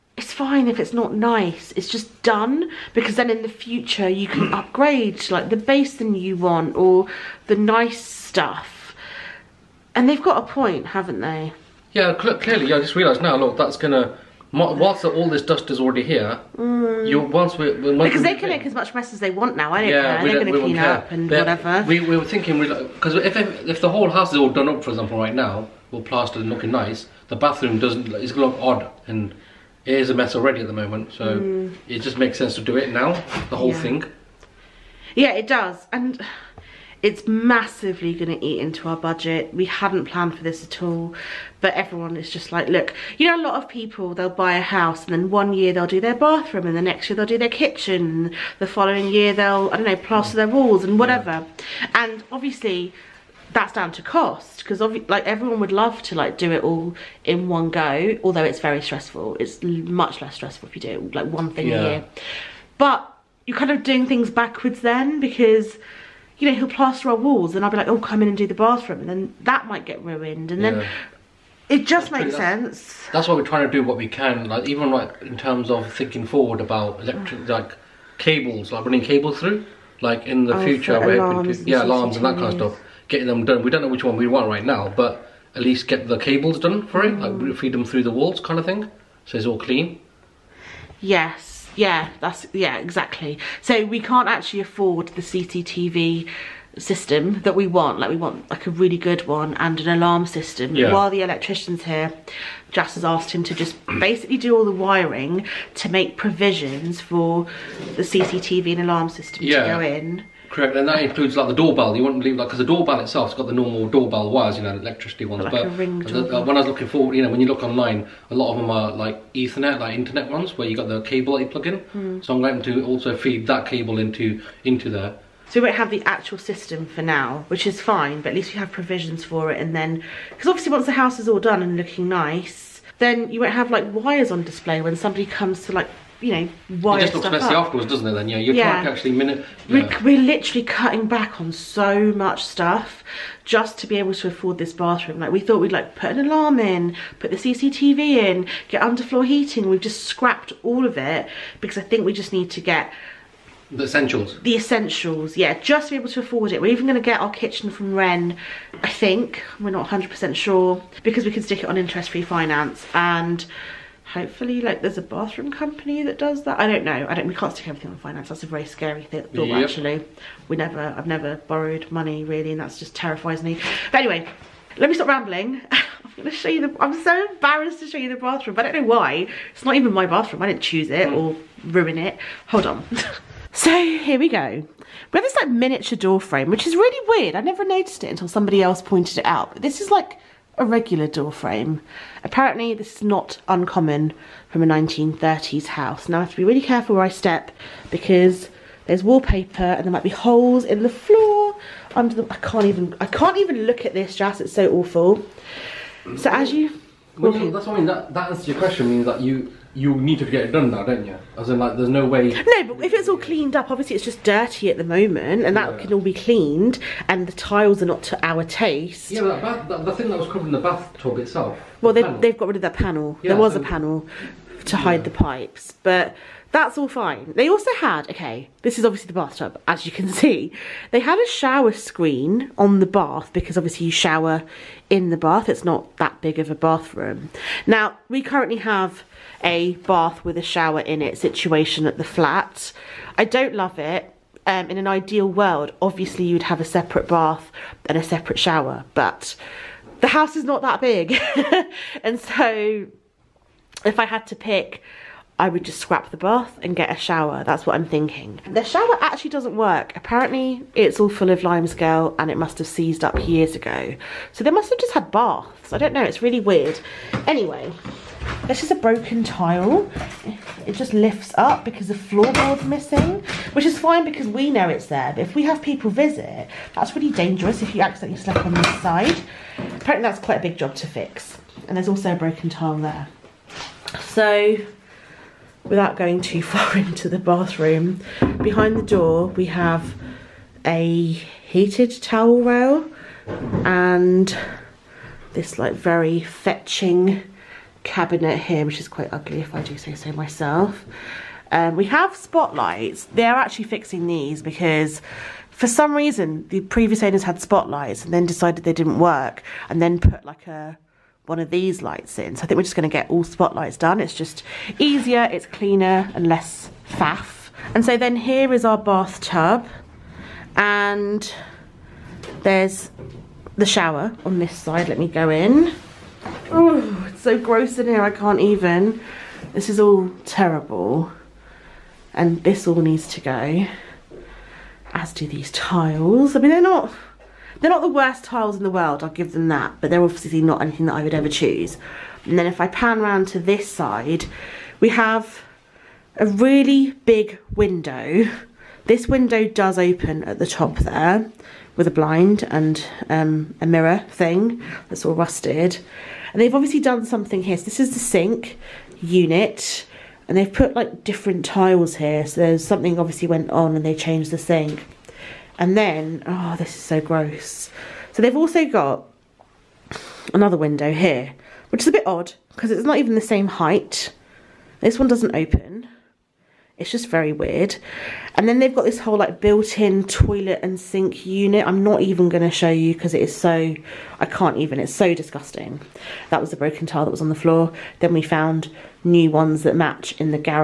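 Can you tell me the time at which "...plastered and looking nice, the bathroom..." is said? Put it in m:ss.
0:26.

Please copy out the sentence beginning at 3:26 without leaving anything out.
that's what I mean, that, that answers your question, means that you you need to get it done now, don't you?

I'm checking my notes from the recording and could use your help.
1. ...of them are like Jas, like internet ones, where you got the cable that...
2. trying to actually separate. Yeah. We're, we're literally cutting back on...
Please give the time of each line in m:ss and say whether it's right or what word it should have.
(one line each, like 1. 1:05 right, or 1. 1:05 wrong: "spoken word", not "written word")
1. 1:58 wrong: "Ethernet", not "Jas"
2. 2:18 wrong: "minute", not "separate".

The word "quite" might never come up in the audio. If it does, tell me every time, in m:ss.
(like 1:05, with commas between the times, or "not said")
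4:40, 4:58.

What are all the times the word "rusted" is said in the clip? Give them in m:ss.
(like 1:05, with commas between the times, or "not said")
5:55.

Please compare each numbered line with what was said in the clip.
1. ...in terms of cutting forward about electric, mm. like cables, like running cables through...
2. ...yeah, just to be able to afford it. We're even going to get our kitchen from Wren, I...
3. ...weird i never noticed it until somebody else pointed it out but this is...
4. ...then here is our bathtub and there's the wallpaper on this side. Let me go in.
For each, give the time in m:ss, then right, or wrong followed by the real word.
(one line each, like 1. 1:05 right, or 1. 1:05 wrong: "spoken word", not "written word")
1. 1:15 wrong: "thinking", not "cutting"
2. 2:35 right
3. 3:07 right
4. 5:17 wrong: "shower", not "wallpaper".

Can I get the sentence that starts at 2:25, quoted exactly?
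Like we thought we'd like put an alarm in, put the CCTV in, get underfloor heating.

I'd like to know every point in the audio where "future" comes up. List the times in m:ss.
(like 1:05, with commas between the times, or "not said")
0:03, 1:20.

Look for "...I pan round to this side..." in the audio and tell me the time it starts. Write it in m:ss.
5:42.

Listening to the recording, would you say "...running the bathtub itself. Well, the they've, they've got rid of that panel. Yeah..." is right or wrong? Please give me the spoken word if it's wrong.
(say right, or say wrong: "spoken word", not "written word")
wrong: "covering", not "running".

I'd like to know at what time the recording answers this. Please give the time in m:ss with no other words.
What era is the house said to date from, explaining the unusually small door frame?
3:14.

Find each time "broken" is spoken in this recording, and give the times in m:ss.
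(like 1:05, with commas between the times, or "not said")
4:28, 4:42, 6:26.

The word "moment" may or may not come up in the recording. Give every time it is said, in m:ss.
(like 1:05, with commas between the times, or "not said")
0:30, 3:34.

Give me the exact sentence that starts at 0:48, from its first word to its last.
the following year they'll, I don't know, plaster their walls and whatever.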